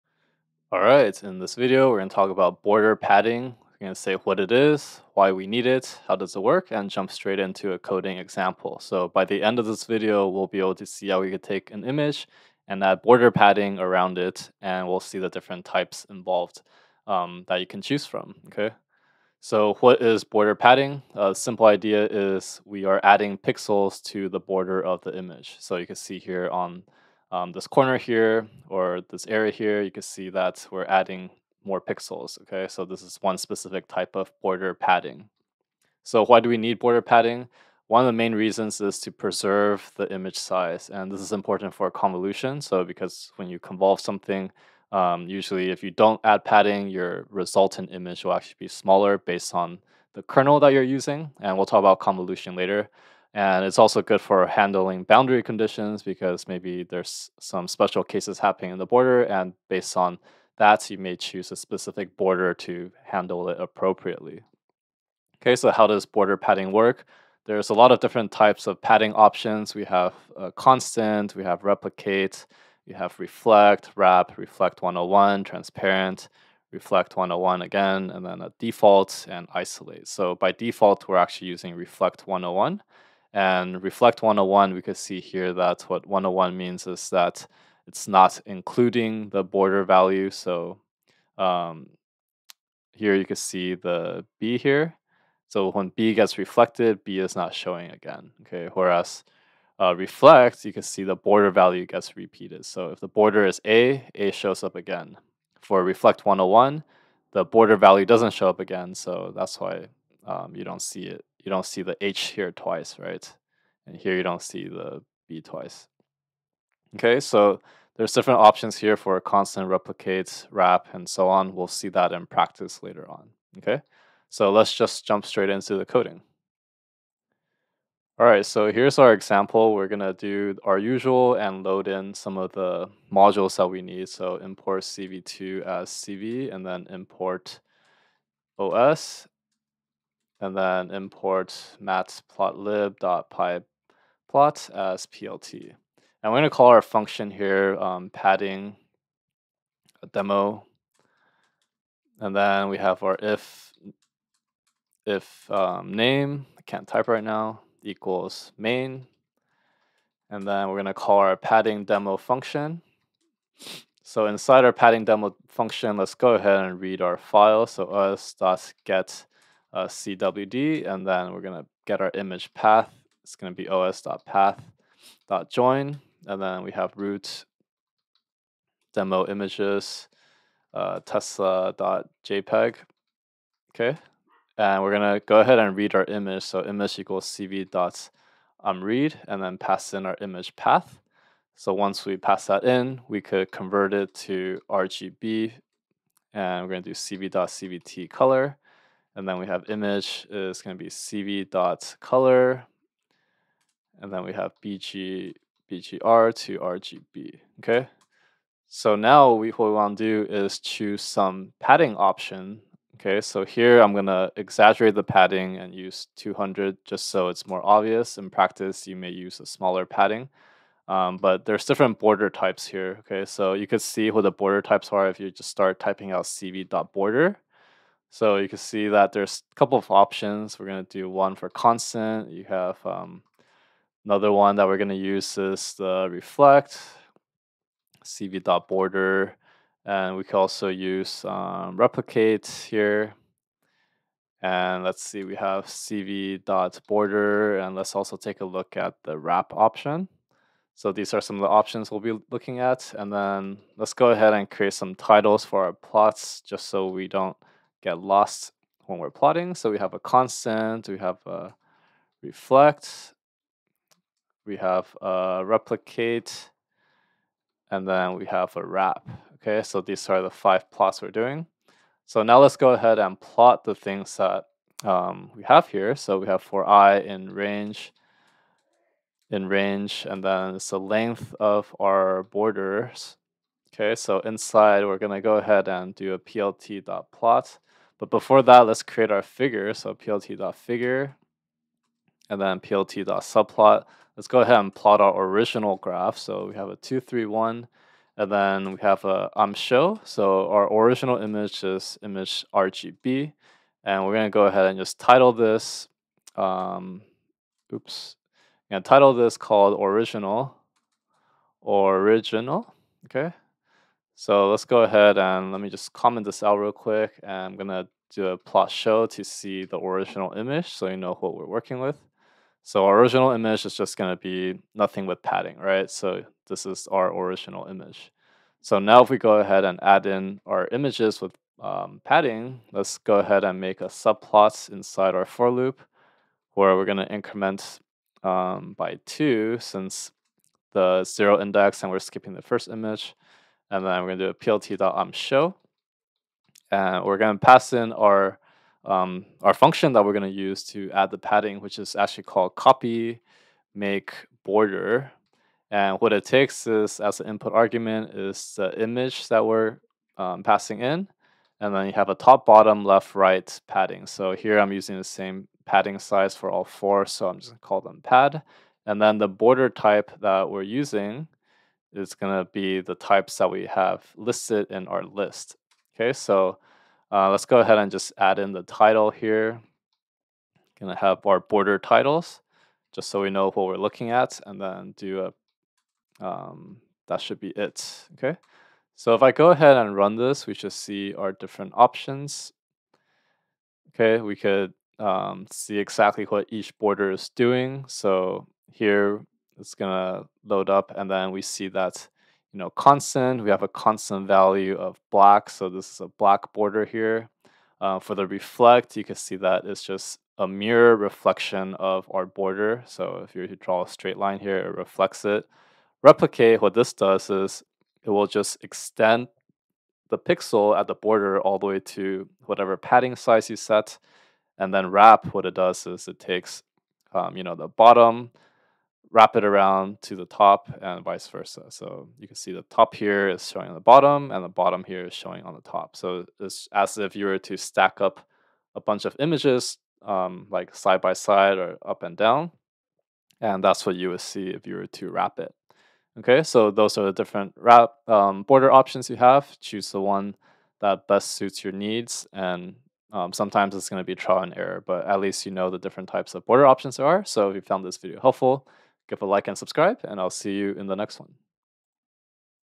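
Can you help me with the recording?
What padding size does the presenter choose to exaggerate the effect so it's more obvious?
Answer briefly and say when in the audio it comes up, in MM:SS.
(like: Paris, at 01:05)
200, at 03:36.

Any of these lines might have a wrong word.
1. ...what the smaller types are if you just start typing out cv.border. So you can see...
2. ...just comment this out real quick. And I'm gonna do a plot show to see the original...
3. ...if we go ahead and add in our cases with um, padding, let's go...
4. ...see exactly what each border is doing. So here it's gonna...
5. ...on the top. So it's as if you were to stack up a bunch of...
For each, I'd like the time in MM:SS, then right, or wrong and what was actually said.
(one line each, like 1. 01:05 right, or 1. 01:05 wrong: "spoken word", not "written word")
1. 03:44 wrong: "border", not "smaller"
2. 05:15 right
3. 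05:29 wrong: "images", not "cases"
4. 06:35 right
5. 07:15 right.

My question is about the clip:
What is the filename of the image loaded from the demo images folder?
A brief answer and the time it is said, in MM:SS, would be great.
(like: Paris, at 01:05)
tesla.jpg, at 03:01.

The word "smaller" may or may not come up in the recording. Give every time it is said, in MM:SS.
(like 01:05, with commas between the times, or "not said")
00:48, 03:39.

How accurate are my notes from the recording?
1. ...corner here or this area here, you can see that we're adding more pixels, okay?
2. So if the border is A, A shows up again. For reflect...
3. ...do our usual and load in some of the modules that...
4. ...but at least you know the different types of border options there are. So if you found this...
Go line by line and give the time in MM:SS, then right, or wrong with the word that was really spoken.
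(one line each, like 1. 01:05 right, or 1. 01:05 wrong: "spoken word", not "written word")
1. 00:27 right
2. 01:42 right
3. 02:10 right
4. 07:34 right.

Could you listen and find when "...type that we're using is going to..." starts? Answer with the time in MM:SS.
06:09.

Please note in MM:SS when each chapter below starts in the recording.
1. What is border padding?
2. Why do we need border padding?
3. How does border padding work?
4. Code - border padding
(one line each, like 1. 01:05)
1. 00:19
2. 00:35
3. 01:04
4. 02:04.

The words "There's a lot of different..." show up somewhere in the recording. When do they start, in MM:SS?
01:07.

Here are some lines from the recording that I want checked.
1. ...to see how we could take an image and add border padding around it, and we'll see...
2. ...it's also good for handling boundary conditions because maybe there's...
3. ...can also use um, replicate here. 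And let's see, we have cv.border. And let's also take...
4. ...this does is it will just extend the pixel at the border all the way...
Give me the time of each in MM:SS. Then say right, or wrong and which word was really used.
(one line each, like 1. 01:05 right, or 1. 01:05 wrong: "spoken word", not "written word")
1. 00:10 right
2. 00:53 right
3. 04:00 right
4. 06:56 right.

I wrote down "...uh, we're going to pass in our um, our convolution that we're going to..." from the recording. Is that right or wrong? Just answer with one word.
wrong.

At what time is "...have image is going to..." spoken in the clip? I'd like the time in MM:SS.
03:19.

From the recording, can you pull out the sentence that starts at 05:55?
And what it takes is as an input argument is the image that we're um, passing in.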